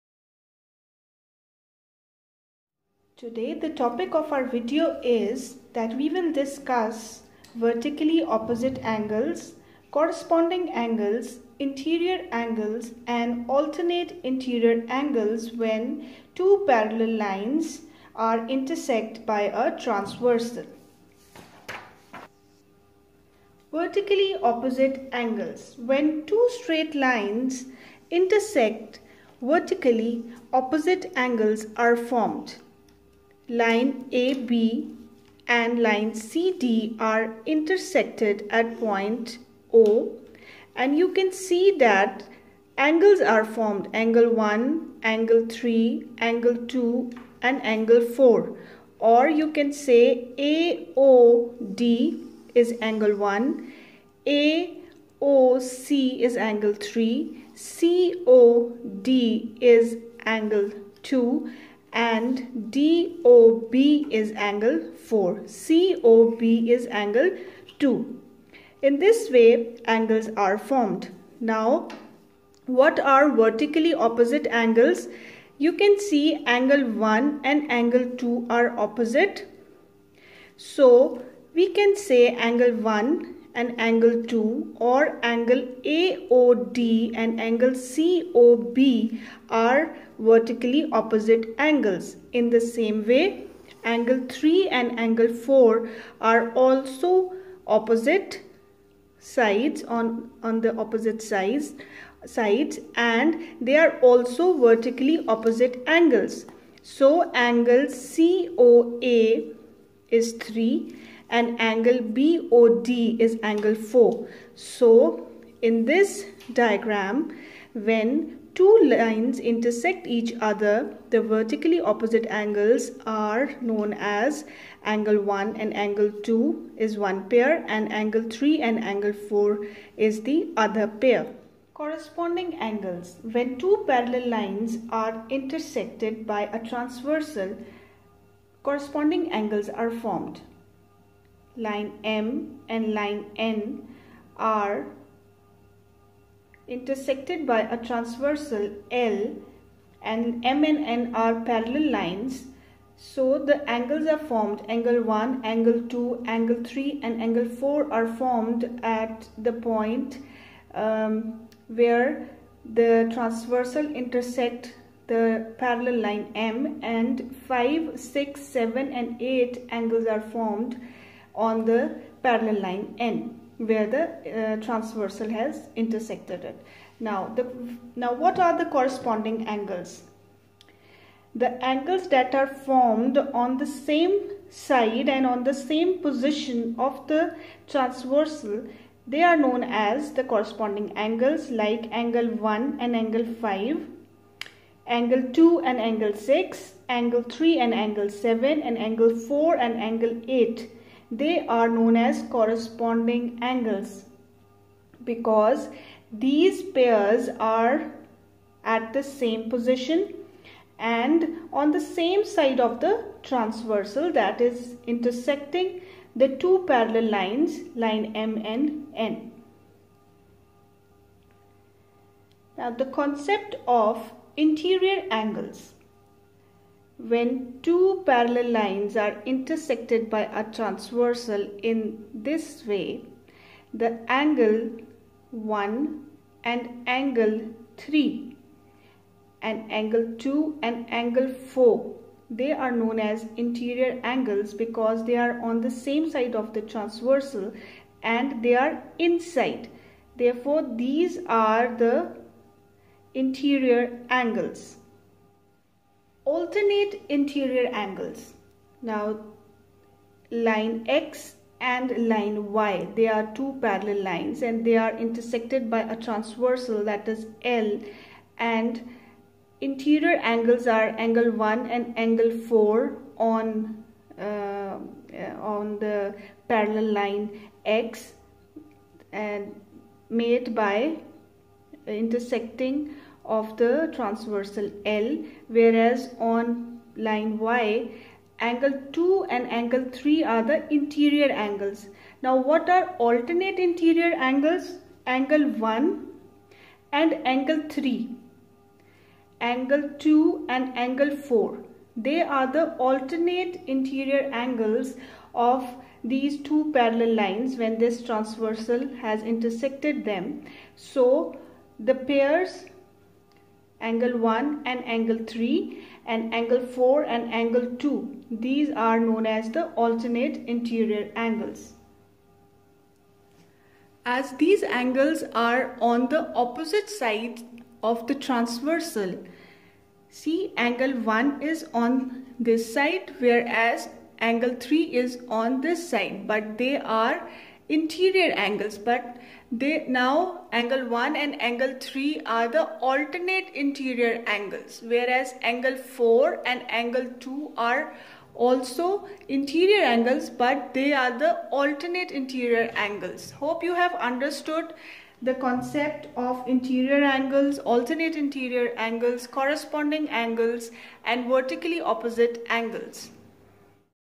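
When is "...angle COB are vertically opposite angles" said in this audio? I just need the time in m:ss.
1:27.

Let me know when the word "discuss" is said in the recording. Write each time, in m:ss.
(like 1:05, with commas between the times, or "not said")
0:06.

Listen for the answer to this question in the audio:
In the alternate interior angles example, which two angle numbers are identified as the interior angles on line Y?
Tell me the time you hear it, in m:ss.
4:48.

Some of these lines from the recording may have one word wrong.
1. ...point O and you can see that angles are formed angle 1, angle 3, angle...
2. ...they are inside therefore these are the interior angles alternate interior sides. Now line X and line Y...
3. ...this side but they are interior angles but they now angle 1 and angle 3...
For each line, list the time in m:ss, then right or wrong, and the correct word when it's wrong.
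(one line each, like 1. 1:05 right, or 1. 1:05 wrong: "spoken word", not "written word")
1. 0:38 right
2. 4:08 wrong: "angles", not "sides"
3. 5:35 right.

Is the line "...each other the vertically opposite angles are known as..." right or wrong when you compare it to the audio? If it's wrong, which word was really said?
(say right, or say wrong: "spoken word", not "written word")
right.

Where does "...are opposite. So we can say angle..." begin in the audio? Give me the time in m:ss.
1:18.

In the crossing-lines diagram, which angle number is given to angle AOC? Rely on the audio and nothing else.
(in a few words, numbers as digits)
3.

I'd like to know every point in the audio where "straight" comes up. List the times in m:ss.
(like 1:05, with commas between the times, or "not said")
0:26.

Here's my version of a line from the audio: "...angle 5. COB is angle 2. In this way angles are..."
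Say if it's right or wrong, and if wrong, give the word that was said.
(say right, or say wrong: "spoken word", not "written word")
wrong: "4", not "5".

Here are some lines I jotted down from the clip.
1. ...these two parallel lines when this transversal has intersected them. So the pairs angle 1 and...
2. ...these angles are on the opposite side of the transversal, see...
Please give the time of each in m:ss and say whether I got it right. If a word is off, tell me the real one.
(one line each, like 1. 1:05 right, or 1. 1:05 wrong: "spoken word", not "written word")
1. 5:06 right
2. 5:24 right.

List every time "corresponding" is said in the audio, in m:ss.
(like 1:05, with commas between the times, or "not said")
0:09, 2:11, 2:18, 2:58, 3:10, 3:22, 5:59.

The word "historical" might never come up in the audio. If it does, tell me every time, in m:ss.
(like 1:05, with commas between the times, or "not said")
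not said.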